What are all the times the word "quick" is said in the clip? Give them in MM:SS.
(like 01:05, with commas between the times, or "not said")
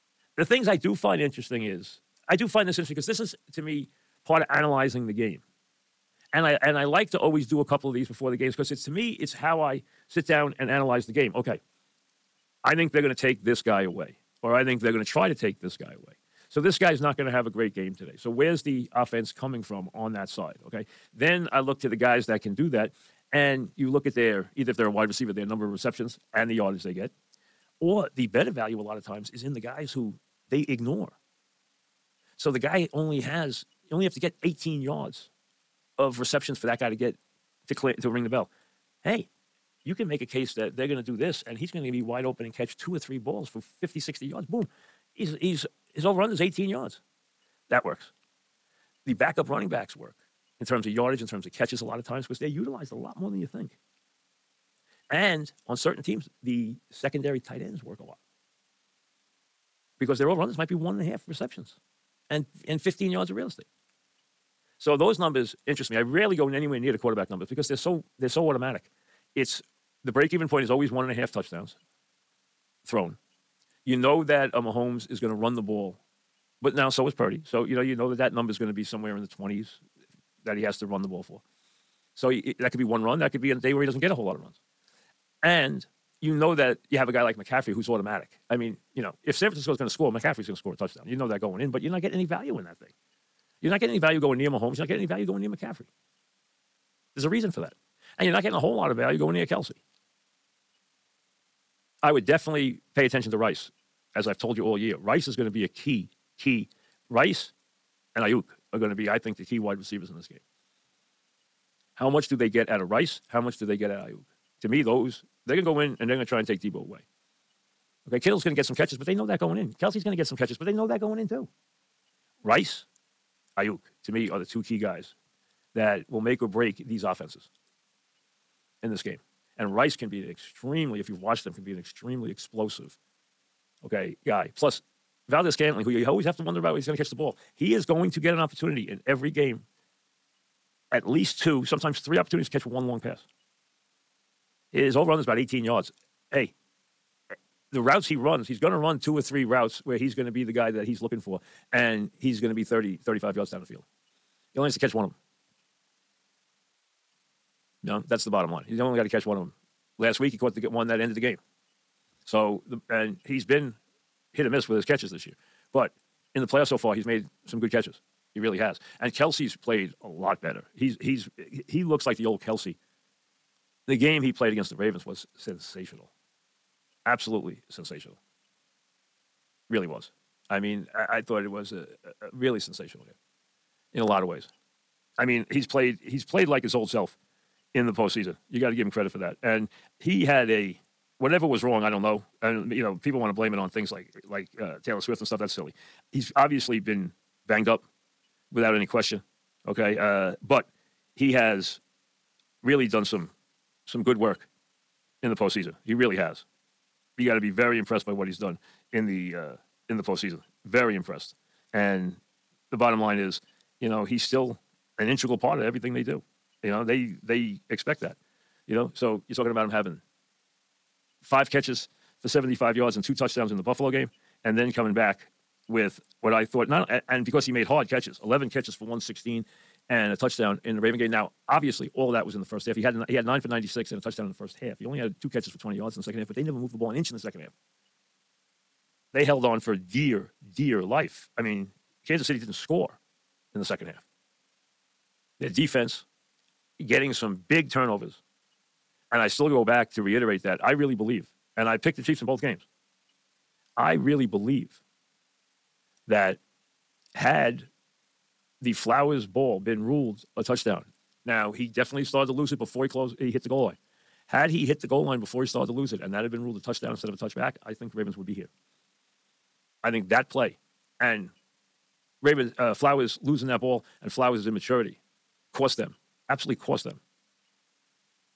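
not said.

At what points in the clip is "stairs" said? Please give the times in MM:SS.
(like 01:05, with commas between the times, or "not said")
not said.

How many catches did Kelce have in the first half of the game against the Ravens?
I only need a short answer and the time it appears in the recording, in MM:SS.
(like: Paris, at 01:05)
9, at 03:53.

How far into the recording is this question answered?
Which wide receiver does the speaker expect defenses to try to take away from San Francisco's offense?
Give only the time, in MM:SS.
01:56.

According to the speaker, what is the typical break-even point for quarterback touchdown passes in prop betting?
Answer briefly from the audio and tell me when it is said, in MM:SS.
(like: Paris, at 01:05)
1.5 touchdowns, at 01:10.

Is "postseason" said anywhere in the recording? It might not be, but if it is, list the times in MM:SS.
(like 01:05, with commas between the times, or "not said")
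03:07, 03:25, 03:30.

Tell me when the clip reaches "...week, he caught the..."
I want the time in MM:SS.
02:40.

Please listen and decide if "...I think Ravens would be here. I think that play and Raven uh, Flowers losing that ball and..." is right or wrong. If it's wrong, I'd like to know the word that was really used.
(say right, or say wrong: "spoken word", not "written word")
right.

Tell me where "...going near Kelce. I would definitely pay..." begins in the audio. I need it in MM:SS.
01:39.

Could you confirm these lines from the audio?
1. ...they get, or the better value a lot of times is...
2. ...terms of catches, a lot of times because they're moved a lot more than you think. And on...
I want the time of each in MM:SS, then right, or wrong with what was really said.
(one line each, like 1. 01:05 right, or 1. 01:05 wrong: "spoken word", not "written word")
1. 00:26 right
2. 00:51 wrong: "utilized", not "moved".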